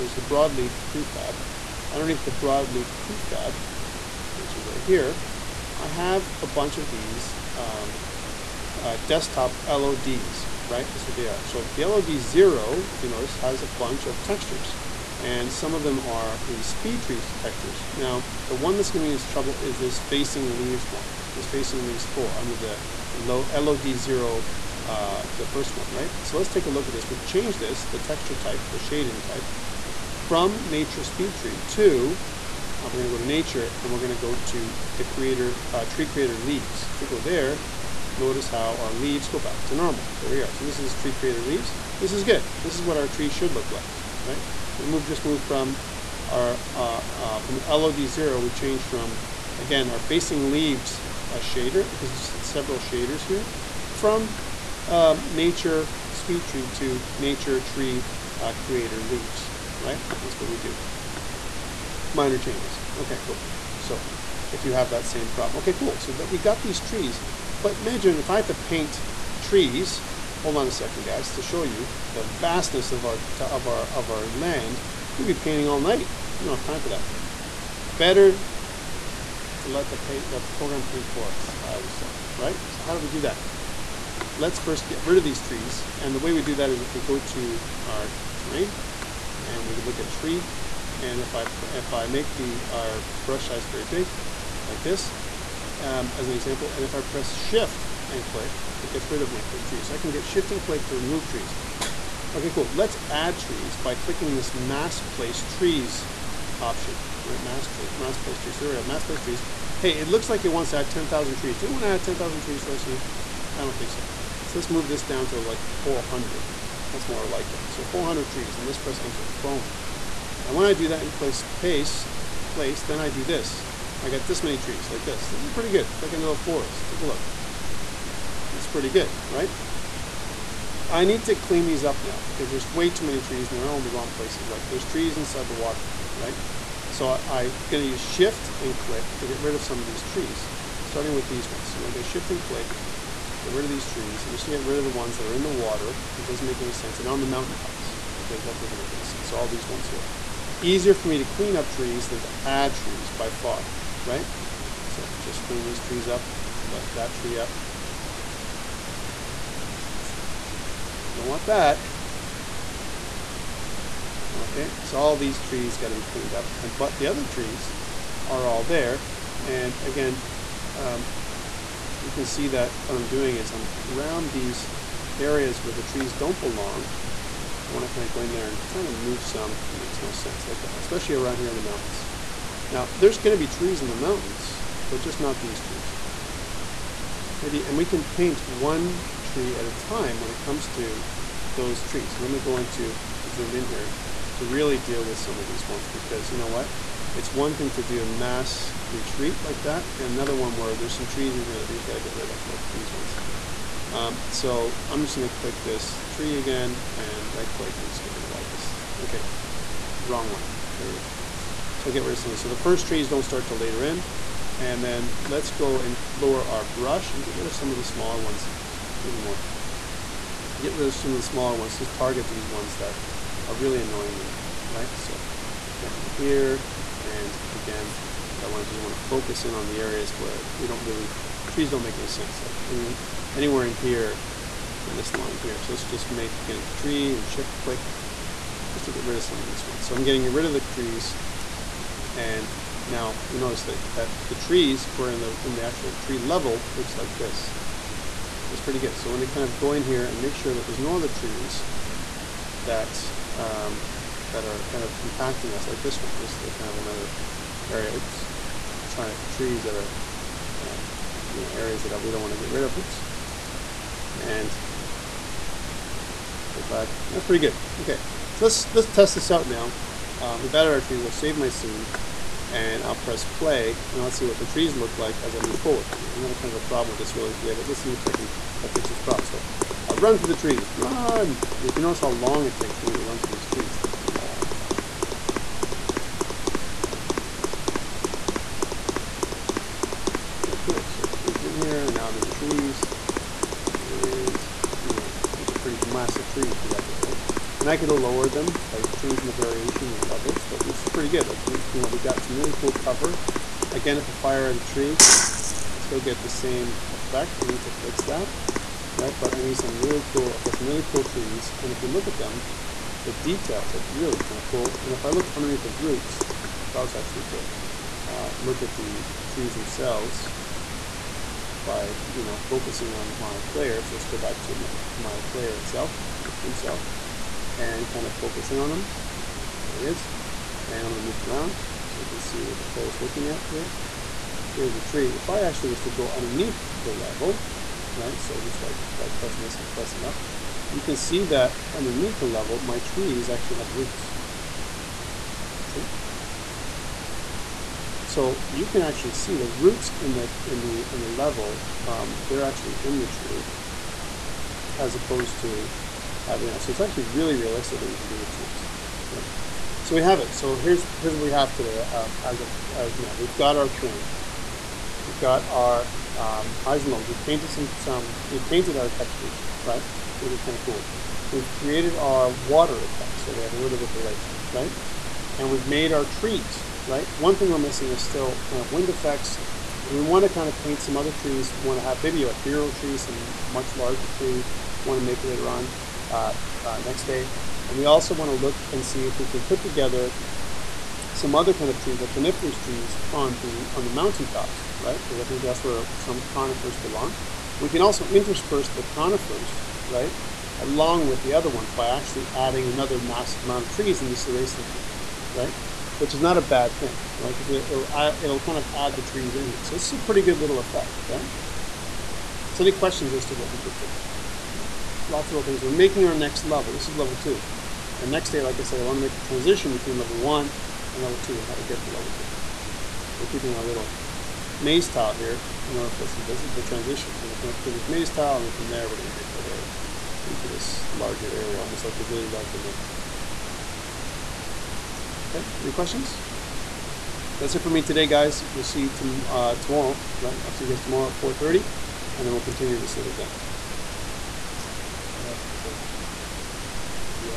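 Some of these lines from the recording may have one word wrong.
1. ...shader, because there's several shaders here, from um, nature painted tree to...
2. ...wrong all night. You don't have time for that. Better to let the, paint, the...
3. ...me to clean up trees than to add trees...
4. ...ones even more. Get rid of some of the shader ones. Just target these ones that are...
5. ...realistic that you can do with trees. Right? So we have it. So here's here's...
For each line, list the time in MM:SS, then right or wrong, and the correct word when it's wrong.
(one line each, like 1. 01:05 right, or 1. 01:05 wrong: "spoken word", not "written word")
1. 00:51 wrong: "speed", not "painted"
2. 01:15 wrong: "painting", not "wrong"
3. 02:31 right
4. 03:38 wrong: "smaller", not "shader"
5. 05:57 right.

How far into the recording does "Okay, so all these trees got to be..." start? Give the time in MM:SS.
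02:44.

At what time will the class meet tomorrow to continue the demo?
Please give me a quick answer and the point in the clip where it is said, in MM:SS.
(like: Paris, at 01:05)
4:30, at 07:21.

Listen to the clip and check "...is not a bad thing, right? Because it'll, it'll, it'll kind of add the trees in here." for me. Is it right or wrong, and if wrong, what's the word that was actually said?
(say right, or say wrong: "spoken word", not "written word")
right.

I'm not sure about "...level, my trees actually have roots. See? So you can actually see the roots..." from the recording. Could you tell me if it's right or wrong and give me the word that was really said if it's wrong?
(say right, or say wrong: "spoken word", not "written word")
right.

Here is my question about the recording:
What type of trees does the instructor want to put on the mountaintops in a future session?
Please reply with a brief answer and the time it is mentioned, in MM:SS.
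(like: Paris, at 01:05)
Coniferous trees, at 06:32.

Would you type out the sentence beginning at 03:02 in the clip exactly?
Now, there's going to be trees in the mountains, but just not these trees.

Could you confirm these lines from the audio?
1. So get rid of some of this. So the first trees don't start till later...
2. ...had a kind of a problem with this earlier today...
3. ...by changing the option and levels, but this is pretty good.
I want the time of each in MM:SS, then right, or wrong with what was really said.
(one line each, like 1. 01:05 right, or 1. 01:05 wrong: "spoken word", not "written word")
1. 03:31 right
2. 04:36 right
3. 04:58 wrong: "variation", not "option".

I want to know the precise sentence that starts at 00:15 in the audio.
And some of them are the speed tree textures.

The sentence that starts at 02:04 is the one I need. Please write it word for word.
I got this many trees, like this.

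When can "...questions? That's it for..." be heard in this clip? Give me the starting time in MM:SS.
07:15.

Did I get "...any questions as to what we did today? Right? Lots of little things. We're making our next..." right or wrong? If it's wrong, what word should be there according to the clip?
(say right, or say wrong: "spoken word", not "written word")
right.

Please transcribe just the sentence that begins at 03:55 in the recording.
So let's just make a tree and shift click, just to get rid of some of these ones.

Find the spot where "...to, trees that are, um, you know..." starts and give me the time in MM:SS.
04:19.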